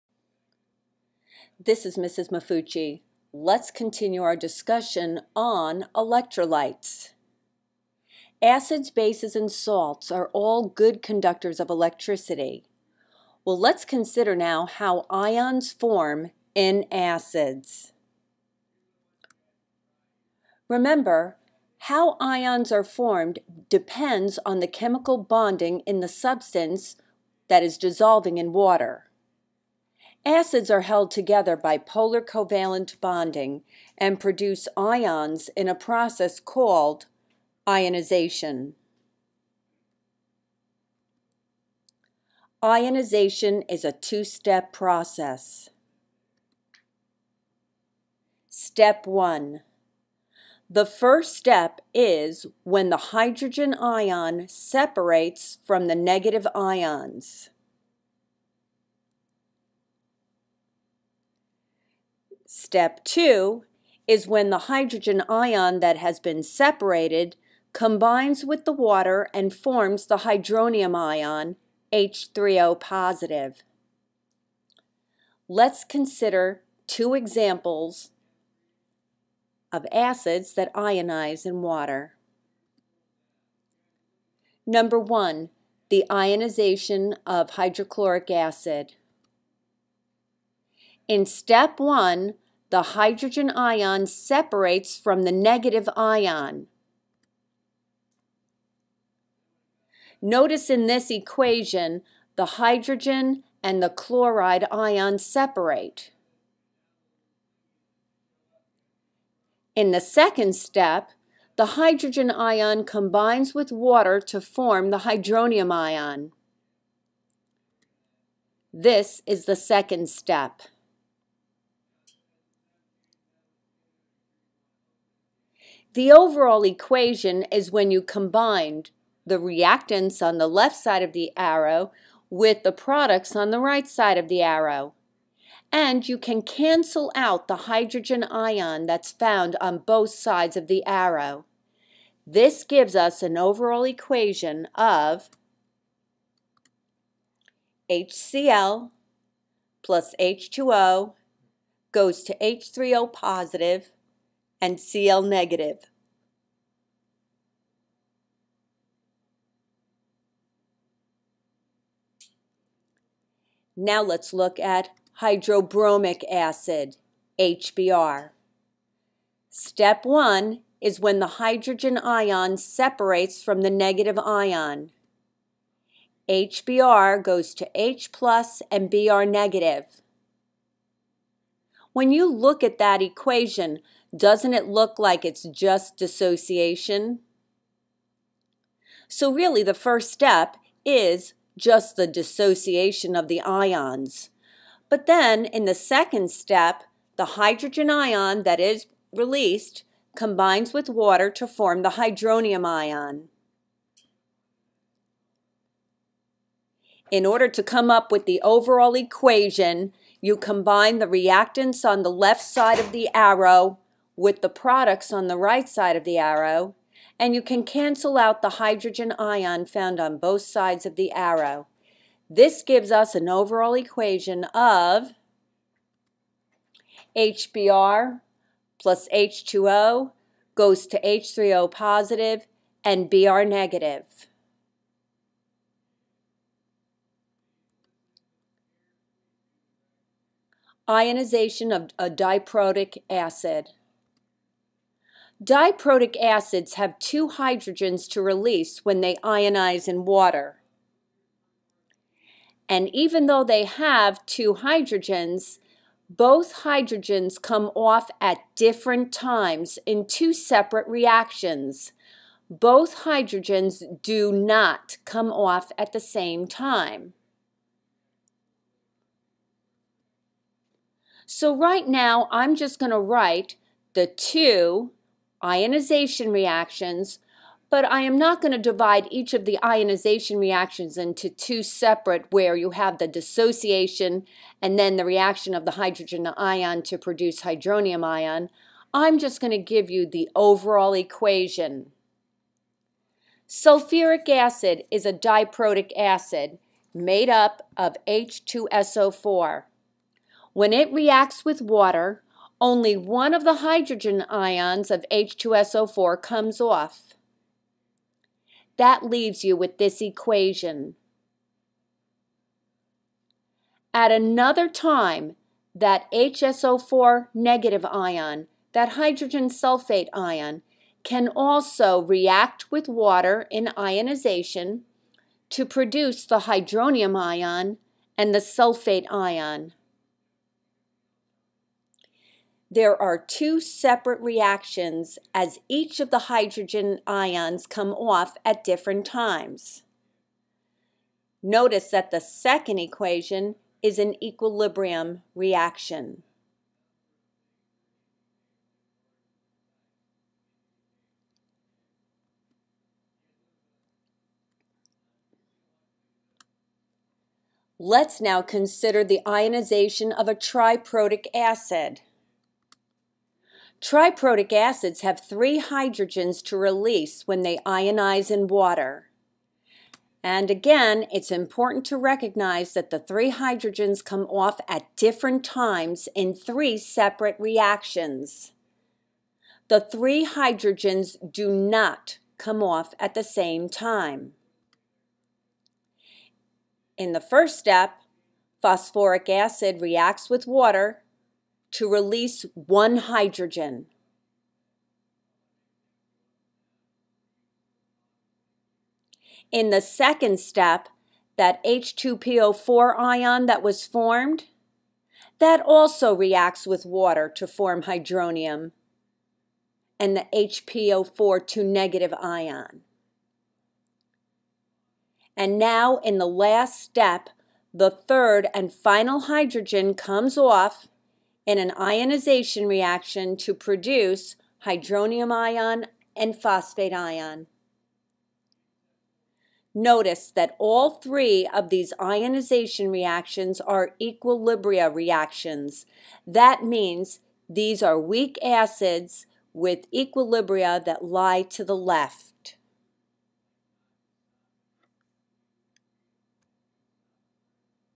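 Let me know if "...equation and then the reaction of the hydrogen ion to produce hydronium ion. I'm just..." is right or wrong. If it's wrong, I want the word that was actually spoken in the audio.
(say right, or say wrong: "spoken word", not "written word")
wrong: "dissociation", not "equation".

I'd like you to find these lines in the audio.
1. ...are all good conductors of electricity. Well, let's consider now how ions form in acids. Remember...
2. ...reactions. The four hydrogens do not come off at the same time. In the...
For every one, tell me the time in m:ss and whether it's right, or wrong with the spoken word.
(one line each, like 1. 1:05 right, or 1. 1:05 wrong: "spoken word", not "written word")
1. 0:10 right
2. 6:17 wrong: "three", not "four".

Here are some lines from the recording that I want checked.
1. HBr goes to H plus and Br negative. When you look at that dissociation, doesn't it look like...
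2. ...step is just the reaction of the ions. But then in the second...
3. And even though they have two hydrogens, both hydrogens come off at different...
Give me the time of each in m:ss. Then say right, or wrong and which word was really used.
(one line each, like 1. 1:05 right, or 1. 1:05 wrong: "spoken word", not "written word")
1. 2:56 wrong: "equation", not "dissociation"
2. 3:10 wrong: "dissociation", not "reaction"
3. 4:12 right.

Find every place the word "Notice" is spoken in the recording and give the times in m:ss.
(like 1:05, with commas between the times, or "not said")
1:40, 5:41, 7:09.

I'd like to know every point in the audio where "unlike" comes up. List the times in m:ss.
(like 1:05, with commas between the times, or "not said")
not said.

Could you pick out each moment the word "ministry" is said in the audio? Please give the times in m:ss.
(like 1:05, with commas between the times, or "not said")
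not said.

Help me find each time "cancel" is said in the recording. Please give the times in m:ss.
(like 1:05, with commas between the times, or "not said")
2:16, 3:37.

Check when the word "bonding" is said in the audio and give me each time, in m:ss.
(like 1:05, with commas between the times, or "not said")
0:25, 0:33.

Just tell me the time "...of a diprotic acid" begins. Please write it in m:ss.
4:01.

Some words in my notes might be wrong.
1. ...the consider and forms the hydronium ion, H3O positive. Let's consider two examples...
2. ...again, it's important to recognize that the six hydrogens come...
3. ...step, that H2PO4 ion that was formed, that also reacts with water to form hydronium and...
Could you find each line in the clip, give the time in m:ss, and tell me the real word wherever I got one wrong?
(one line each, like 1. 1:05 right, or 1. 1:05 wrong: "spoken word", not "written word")
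1. 1:08 wrong: "water", not "consider"
2. 6:10 wrong: "three", not "six"
3. 6:40 right.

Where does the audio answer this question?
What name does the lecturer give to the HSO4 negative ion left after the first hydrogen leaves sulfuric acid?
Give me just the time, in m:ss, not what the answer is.
5:18.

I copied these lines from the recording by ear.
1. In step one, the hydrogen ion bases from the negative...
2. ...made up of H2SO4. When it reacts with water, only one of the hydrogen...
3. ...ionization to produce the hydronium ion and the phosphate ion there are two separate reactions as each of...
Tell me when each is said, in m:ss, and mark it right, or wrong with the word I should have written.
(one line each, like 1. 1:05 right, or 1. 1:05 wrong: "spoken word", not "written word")
1. 1:31 wrong: "separates", not "bases"
2. 4:56 right
3. 5:23 wrong: "sulfate", not "phosphate".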